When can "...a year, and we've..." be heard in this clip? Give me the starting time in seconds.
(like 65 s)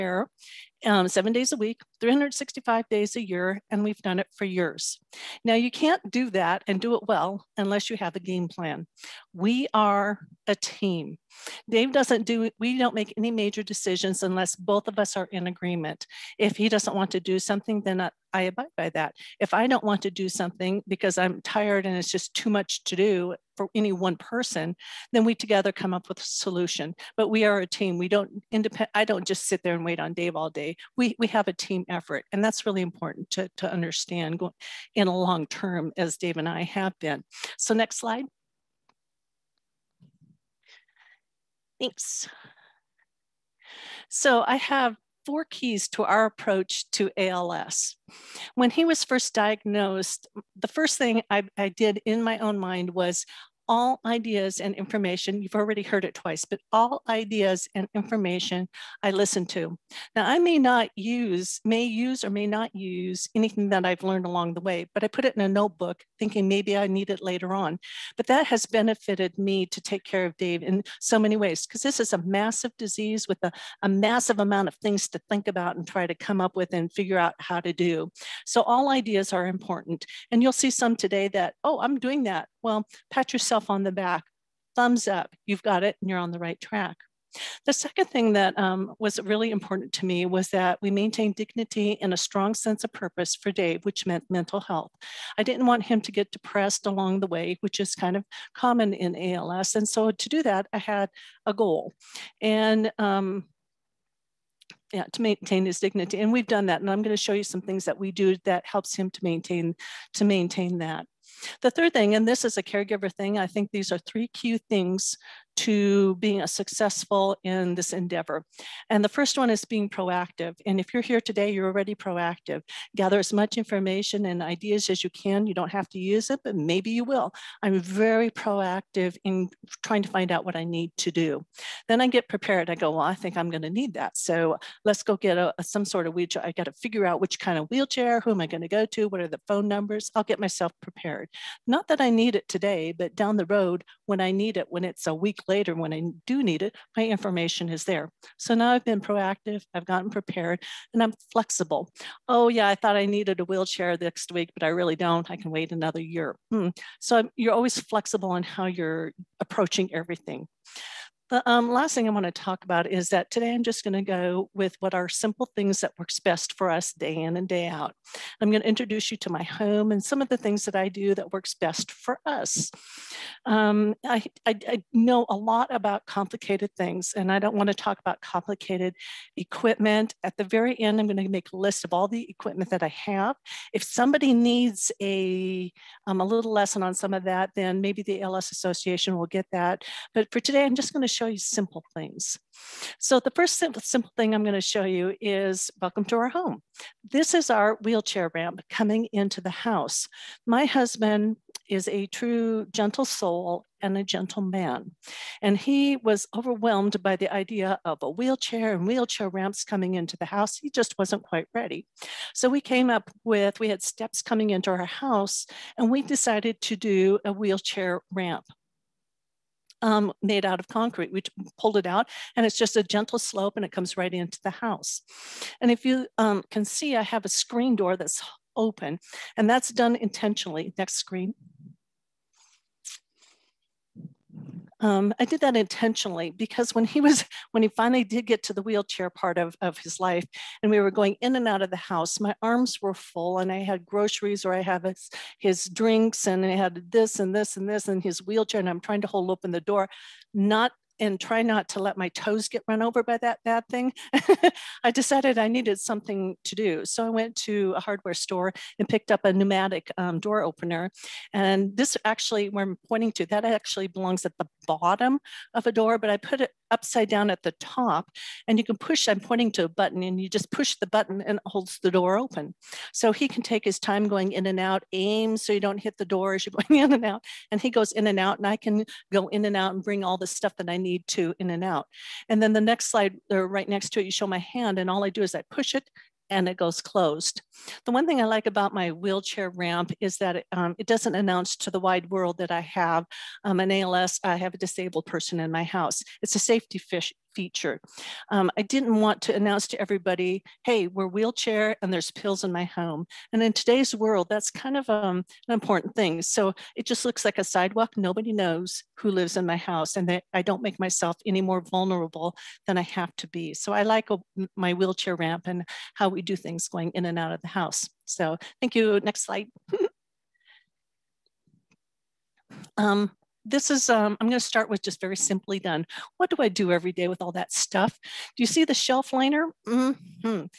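3 s.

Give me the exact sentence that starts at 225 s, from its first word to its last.
And if you um, can see, I have a screen door that's open and that's done intentionally.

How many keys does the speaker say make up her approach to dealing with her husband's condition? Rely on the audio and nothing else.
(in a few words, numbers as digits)
4.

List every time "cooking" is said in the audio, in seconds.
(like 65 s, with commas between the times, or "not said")
not said.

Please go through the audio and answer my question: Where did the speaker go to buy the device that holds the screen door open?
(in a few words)
hardware store.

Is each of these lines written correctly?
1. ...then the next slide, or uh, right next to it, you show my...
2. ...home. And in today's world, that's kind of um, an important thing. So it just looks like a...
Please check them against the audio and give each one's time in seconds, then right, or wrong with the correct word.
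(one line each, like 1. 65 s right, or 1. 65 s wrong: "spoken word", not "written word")
1. 282 s right
2. 302 s right.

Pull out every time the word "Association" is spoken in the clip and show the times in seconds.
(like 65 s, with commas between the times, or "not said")
188 s.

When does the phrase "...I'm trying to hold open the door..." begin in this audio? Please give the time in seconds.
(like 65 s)
248 s.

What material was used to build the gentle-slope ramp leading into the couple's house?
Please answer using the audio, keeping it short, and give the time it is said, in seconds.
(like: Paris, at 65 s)
concrete, at 220 s.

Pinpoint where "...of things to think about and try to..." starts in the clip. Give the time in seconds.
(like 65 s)
74 s.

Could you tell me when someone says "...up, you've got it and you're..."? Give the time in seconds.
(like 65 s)
85 s.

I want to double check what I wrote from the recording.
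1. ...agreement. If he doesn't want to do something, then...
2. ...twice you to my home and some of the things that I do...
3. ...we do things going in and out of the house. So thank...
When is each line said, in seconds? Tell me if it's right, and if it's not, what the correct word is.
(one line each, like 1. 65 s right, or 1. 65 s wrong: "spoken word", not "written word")
1. 15 s right
2. 168 s wrong: "introduce", not "twice"
3. 316 s right.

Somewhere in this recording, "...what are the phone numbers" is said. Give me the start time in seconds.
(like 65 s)
139 s.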